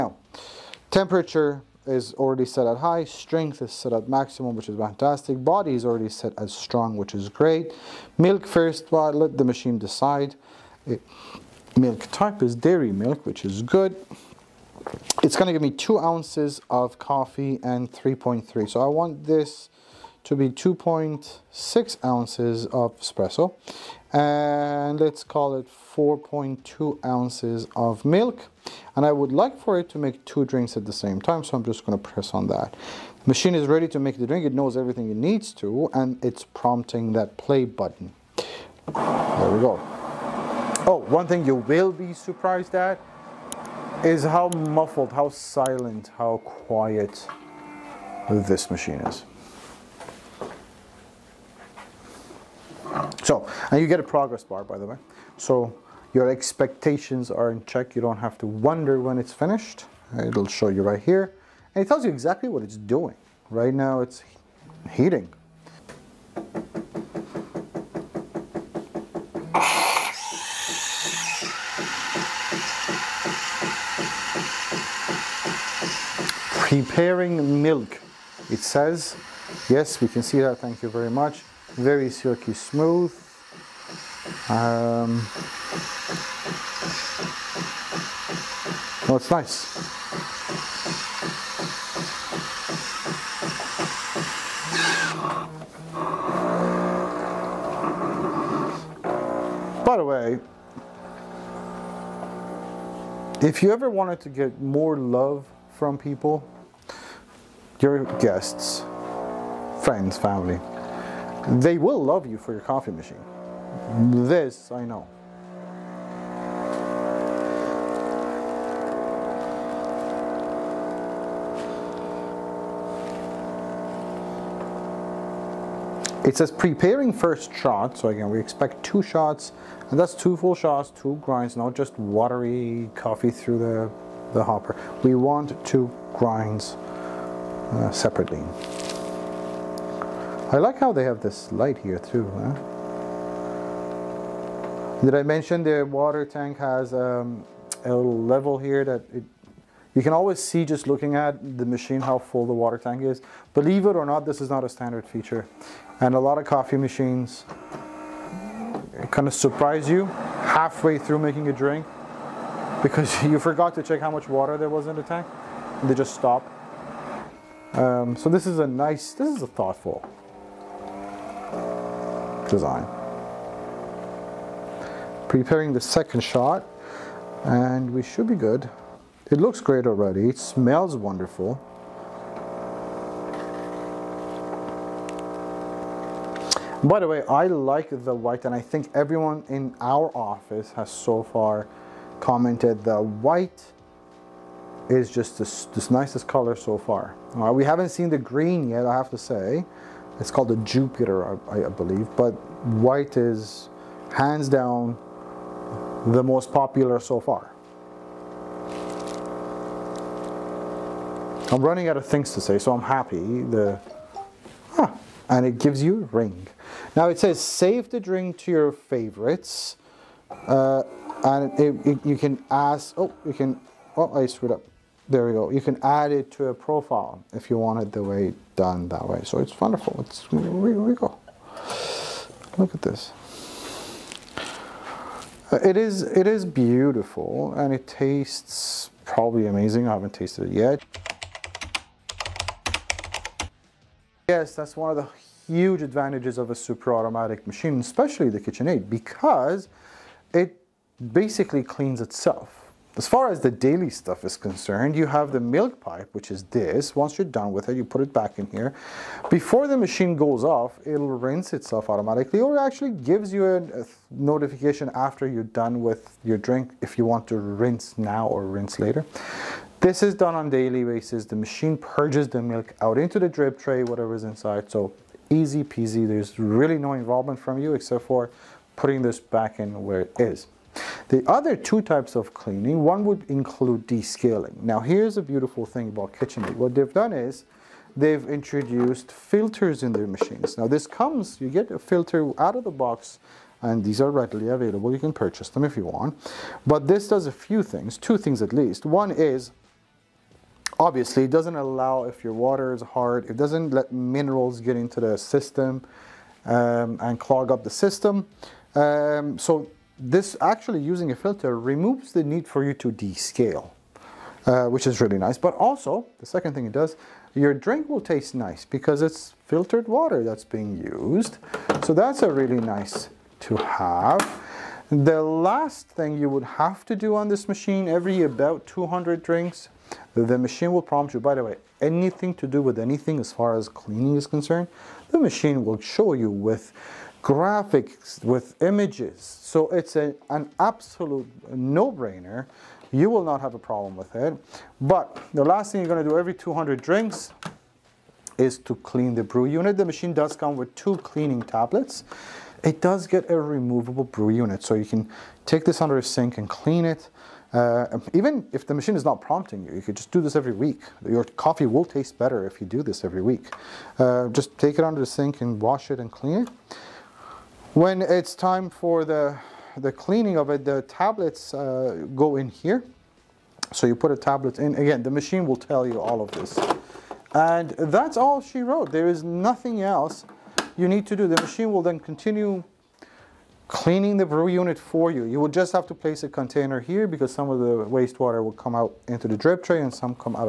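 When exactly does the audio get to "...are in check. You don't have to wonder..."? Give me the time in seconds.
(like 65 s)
57 s.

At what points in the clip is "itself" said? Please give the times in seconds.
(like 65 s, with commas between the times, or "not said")
252 s, 261 s.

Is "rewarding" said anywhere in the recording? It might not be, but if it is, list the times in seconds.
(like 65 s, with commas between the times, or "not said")
not said.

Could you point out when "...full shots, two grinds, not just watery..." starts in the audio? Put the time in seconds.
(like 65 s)
130 s.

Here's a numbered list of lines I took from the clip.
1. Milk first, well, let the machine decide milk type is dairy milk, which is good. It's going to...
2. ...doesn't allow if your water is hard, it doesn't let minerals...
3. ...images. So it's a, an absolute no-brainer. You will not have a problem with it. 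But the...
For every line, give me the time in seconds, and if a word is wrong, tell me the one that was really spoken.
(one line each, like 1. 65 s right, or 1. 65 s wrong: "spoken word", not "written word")
1. 8 s right
2. 301 s right
3. 338 s right.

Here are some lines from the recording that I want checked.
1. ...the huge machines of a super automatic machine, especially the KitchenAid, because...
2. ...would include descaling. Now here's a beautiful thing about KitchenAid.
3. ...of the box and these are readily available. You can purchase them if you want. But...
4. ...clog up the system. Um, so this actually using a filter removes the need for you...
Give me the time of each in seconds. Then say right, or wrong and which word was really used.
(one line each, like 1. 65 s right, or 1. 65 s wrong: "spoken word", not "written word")
1. 244 s wrong: "advantages", not "machines"
2. 283 s right
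3. 292 s right
4. 307 s right.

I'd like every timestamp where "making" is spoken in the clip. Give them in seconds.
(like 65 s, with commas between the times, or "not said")
161 s.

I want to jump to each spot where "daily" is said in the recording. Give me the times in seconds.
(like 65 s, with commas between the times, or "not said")
253 s, 270 s.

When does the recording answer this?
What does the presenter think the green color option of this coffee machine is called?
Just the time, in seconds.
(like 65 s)
200 s.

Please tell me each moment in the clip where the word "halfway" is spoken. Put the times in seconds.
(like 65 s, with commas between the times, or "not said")
160 s.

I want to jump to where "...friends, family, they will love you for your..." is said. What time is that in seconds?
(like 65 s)
109 s.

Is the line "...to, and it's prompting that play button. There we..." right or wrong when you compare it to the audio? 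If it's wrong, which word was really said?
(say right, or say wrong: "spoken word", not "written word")
right.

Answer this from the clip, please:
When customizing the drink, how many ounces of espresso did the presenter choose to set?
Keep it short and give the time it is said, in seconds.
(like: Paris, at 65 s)
2.6 ounces, at 20 s.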